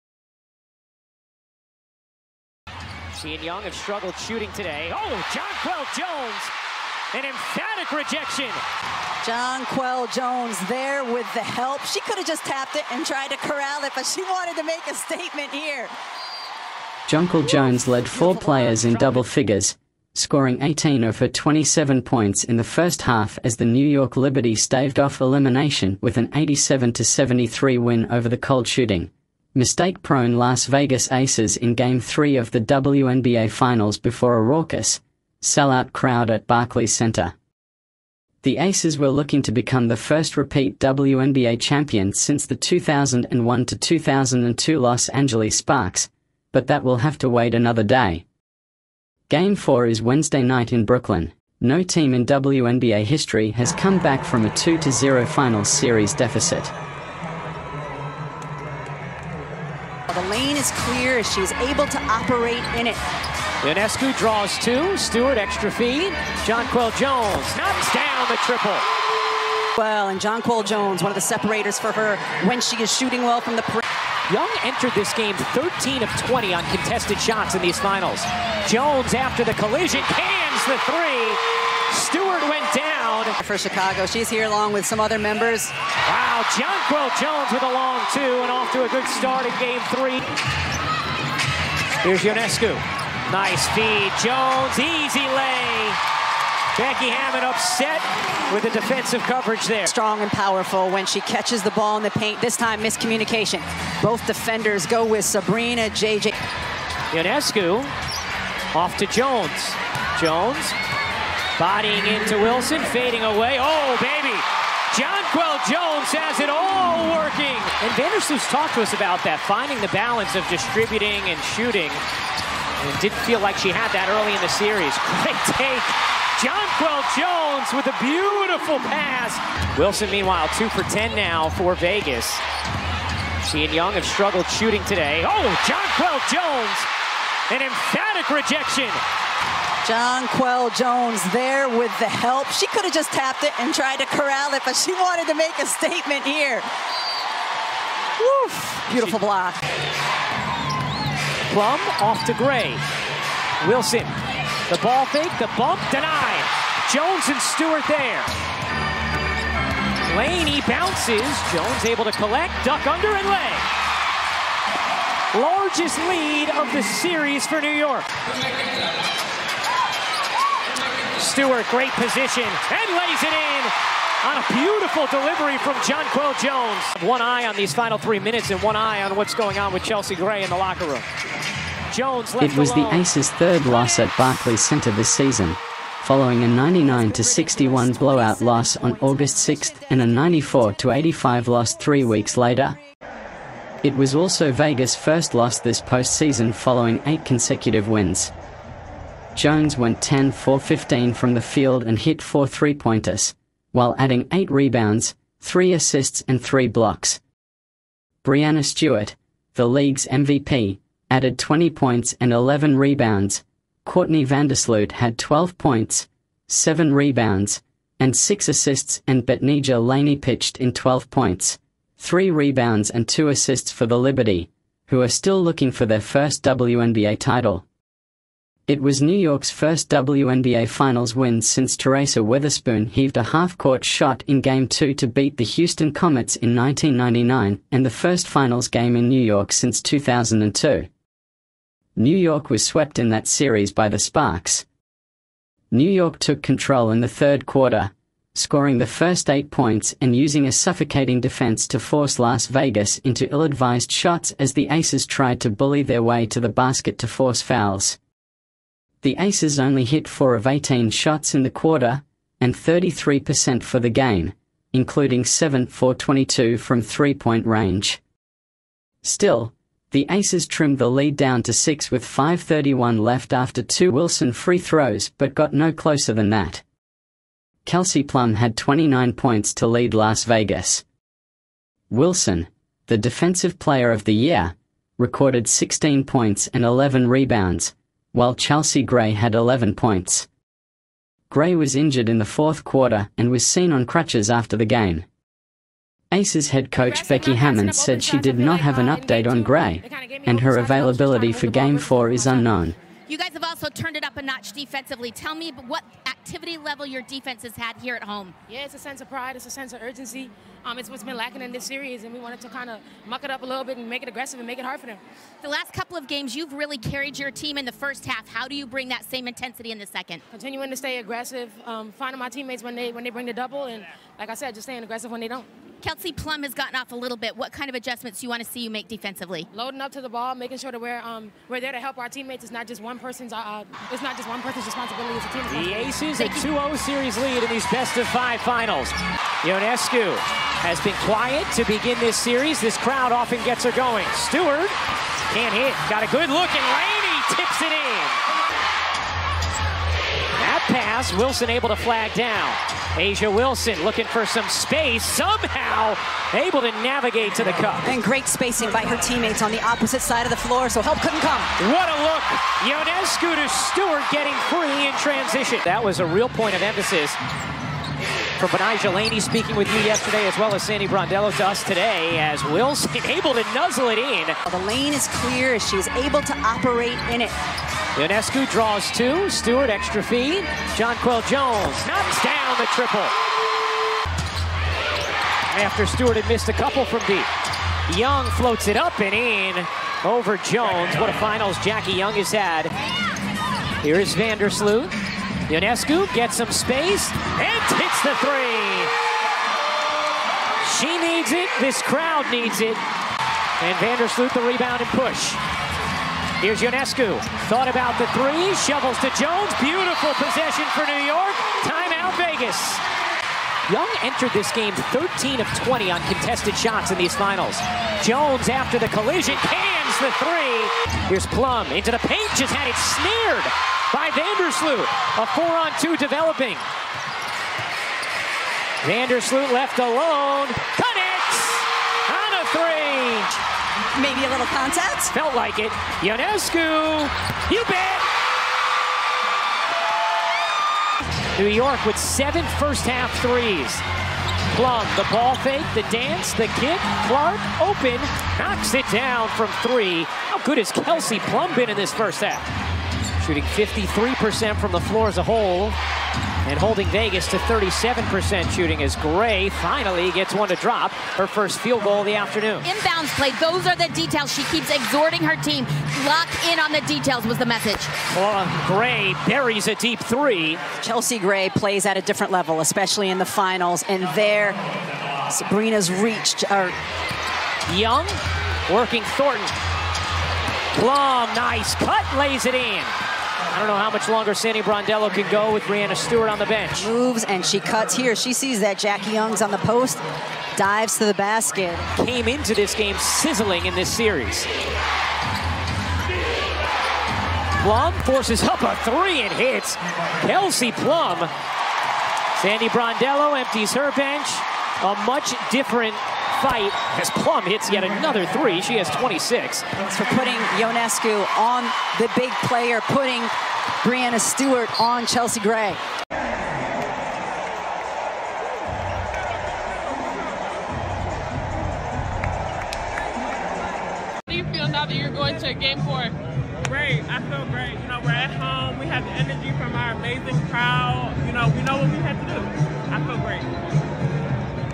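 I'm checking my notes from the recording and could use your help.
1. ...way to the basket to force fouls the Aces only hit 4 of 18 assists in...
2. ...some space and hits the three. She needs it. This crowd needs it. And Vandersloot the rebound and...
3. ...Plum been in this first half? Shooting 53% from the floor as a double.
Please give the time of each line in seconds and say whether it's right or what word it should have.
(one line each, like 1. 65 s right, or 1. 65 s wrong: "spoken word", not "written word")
1. 256 s wrong: "shots", not "assists"
2. 396 s right
3. 451 s wrong: "whole", not "double".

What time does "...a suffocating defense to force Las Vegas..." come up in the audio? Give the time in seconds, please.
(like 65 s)
250 s.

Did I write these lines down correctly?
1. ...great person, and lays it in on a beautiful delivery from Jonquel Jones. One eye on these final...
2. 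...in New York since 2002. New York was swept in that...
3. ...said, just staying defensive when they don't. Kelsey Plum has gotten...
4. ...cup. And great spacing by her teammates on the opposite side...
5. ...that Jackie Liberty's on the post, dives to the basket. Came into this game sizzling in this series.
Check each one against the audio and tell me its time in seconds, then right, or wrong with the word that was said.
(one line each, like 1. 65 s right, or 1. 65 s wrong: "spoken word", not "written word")
1. 171 s wrong: "position", not "person"
2. 238 s right
3. 324 s wrong: "aggressive", not "defensive"
4. 357 s right
5. 488 s wrong: "Young", not "Liberty".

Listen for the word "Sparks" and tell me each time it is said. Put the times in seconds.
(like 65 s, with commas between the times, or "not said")
45 s, 243 s.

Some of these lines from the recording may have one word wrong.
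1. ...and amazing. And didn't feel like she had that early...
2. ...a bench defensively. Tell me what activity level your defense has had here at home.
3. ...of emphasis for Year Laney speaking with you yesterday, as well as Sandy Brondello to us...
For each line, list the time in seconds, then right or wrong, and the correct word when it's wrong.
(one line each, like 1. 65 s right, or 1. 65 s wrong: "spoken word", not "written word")
1. 121 s wrong: "shooting", not "amazing"
2. 304 s wrong: "notch", not "bench"
3. 366 s wrong: "Betnijah", not "Year".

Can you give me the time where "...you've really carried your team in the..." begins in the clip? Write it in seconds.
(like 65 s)
316 s.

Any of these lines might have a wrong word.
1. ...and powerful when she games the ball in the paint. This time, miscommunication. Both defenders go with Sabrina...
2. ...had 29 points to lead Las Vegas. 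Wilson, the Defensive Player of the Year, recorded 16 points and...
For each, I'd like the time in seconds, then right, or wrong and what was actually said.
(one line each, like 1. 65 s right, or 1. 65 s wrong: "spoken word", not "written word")
1. 100 s wrong: "catches", not "games"
2. 278 s right.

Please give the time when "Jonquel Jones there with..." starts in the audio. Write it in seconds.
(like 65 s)
9 s.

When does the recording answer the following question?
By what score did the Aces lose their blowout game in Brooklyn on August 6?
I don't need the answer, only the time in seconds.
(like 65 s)
186 s.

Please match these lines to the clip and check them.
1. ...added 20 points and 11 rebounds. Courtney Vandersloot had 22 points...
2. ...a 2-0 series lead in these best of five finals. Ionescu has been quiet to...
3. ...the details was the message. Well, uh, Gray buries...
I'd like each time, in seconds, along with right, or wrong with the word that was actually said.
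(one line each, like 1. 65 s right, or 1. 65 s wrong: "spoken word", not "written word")
1. 211 s wrong: "12", not "22"
2. 336 s right
3. 466 s right.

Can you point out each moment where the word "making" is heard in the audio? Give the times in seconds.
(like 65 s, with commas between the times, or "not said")
330 s.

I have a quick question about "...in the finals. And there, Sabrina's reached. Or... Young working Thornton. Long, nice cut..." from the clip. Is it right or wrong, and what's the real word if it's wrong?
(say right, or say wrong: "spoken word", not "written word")
right.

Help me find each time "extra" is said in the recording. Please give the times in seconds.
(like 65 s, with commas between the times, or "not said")
65 s, 379 s.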